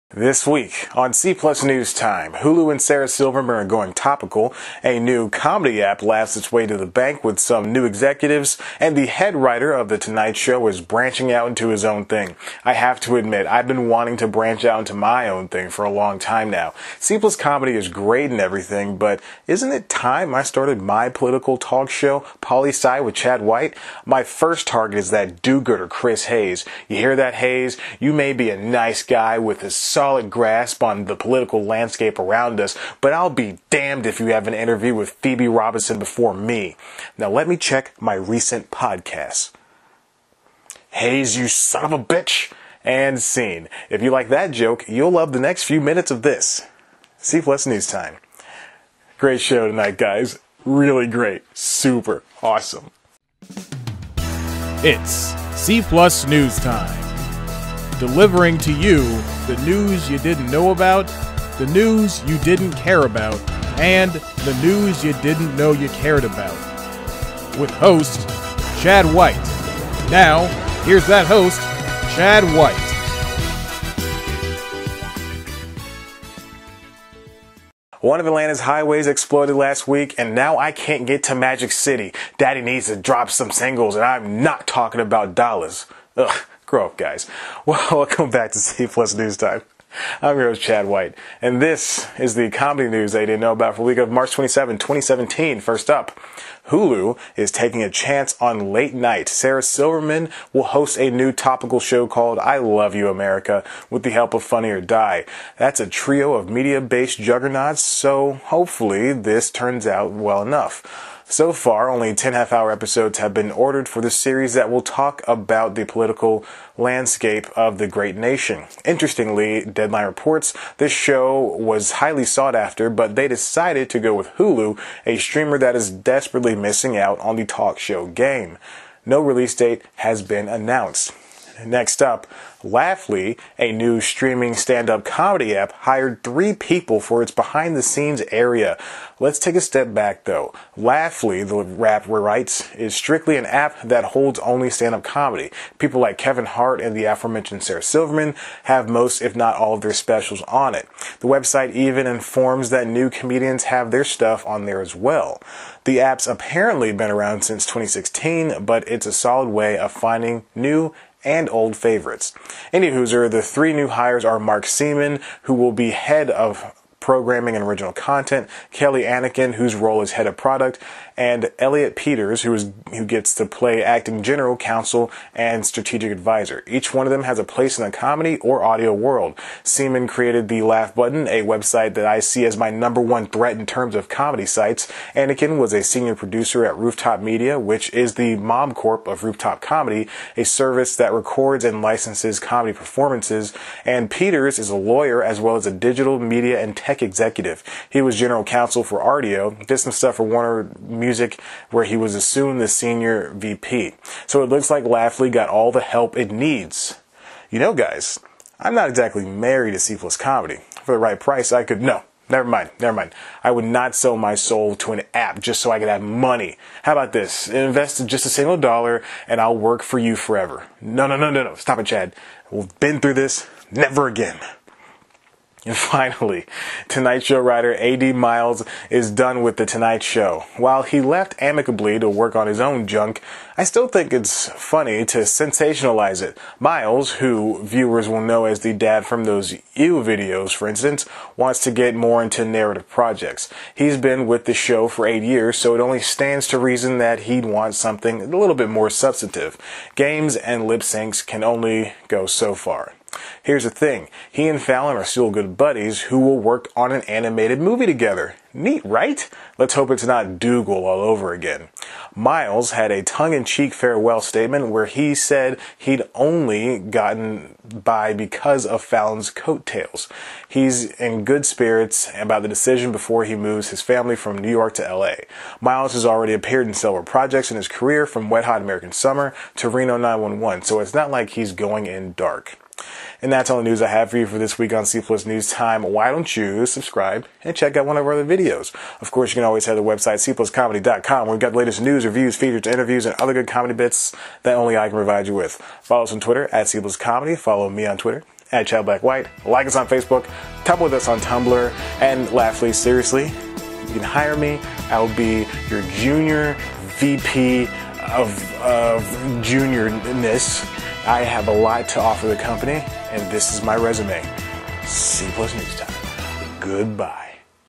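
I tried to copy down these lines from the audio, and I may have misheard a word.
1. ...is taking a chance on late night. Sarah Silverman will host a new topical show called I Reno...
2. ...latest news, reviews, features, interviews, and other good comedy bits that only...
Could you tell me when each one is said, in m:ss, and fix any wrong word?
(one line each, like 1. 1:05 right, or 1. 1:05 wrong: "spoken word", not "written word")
1. 1:37 wrong: "Love", not "Reno"
2. 4:51 right.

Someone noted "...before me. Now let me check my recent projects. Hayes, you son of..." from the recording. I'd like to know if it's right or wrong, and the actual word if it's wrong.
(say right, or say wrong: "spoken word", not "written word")
wrong: "podcasts", not "projects".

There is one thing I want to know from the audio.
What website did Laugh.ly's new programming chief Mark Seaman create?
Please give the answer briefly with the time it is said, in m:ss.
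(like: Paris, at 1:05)
the Laugh Button, at 3:00.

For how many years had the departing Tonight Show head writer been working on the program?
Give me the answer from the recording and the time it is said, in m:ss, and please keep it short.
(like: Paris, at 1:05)
8, at 4:05.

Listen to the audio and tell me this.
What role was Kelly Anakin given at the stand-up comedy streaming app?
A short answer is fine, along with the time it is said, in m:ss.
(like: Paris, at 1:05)
head of product, at 2:50.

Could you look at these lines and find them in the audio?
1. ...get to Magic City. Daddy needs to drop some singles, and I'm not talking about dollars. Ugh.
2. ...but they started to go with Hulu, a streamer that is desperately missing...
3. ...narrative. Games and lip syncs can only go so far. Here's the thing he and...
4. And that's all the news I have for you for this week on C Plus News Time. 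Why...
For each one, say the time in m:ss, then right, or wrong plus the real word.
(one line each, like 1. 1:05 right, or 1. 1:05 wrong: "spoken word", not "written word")
1. 1:21 right
2. 2:02 wrong: "decided", not "started"
3. 4:08 wrong: "substantive", not "narrative"
4. 4:43 right.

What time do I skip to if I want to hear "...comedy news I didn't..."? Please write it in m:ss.
1:32.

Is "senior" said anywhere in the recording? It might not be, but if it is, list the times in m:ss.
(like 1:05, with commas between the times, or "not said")
3:05, 3:22.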